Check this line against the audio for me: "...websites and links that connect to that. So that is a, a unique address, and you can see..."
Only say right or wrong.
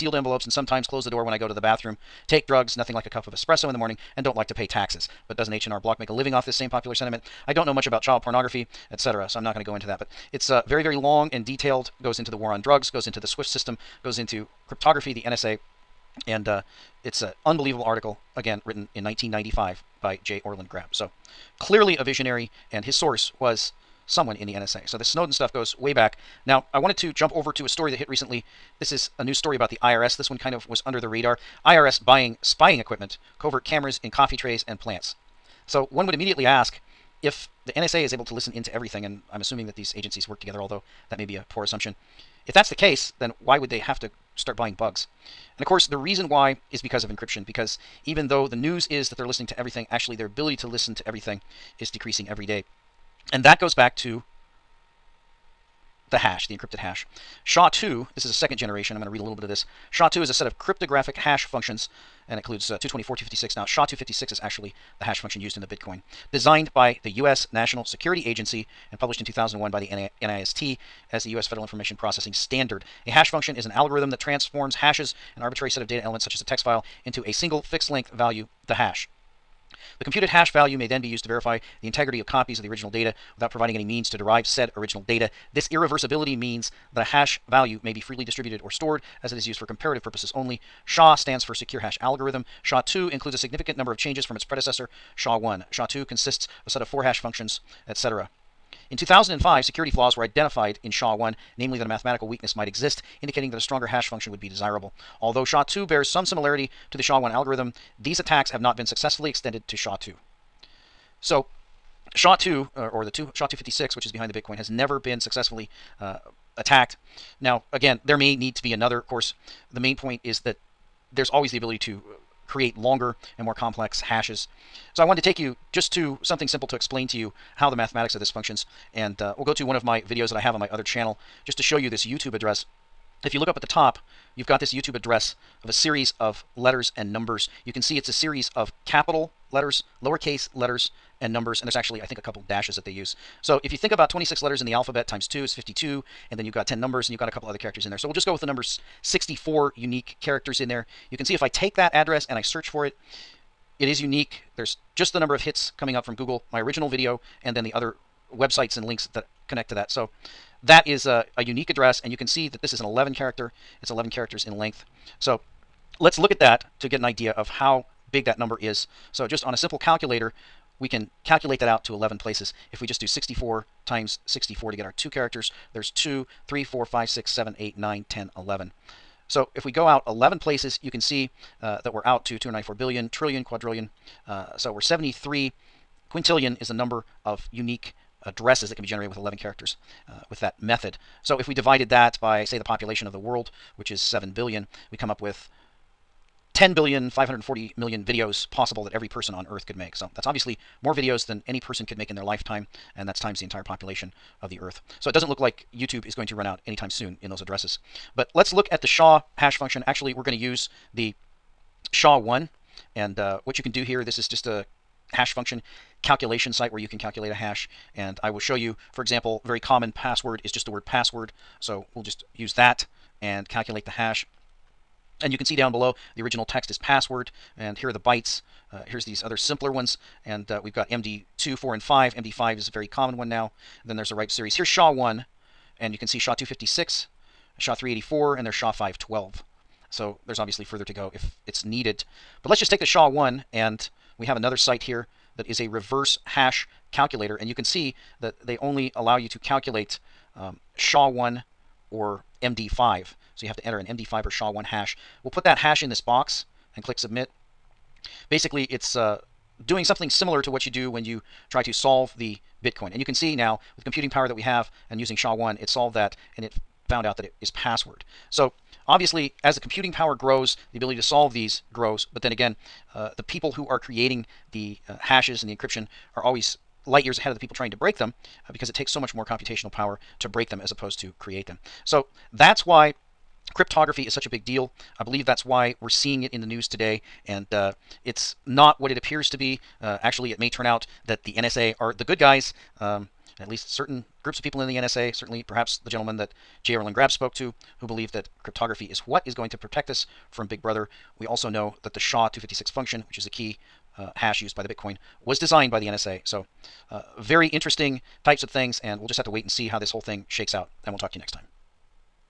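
right.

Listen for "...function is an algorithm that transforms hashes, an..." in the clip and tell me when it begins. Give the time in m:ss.
1:13.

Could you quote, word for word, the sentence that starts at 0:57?
SHA-2, this is a second generation.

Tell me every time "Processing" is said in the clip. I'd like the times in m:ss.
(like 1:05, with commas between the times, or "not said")
1:11.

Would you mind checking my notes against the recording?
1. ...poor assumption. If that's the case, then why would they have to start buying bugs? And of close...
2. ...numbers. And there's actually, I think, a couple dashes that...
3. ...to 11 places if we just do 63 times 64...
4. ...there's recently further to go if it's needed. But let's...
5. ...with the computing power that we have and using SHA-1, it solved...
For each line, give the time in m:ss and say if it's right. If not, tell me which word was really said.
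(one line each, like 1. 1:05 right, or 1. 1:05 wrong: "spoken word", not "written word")
1. 0:41 wrong: "course", not "close"
2. 2:21 right
3. 2:51 wrong: "64", not "63"
4. 4:00 wrong: "obviously", not "recently"
5. 4:23 right.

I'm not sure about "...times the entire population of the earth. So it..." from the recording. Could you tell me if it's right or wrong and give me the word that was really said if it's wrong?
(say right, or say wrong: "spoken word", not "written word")
right.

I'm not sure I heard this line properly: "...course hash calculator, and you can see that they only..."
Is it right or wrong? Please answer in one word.
wrong.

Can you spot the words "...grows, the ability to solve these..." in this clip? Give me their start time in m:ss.
4:30.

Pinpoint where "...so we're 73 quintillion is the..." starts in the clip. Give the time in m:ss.
3:04.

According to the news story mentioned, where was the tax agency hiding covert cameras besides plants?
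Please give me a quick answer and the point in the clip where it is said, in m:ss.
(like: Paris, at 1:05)
Coffee trays, at 0:34.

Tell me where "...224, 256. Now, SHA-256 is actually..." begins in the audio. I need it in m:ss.
1:02.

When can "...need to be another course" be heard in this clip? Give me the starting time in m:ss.
1:58.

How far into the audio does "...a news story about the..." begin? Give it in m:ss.
0:29.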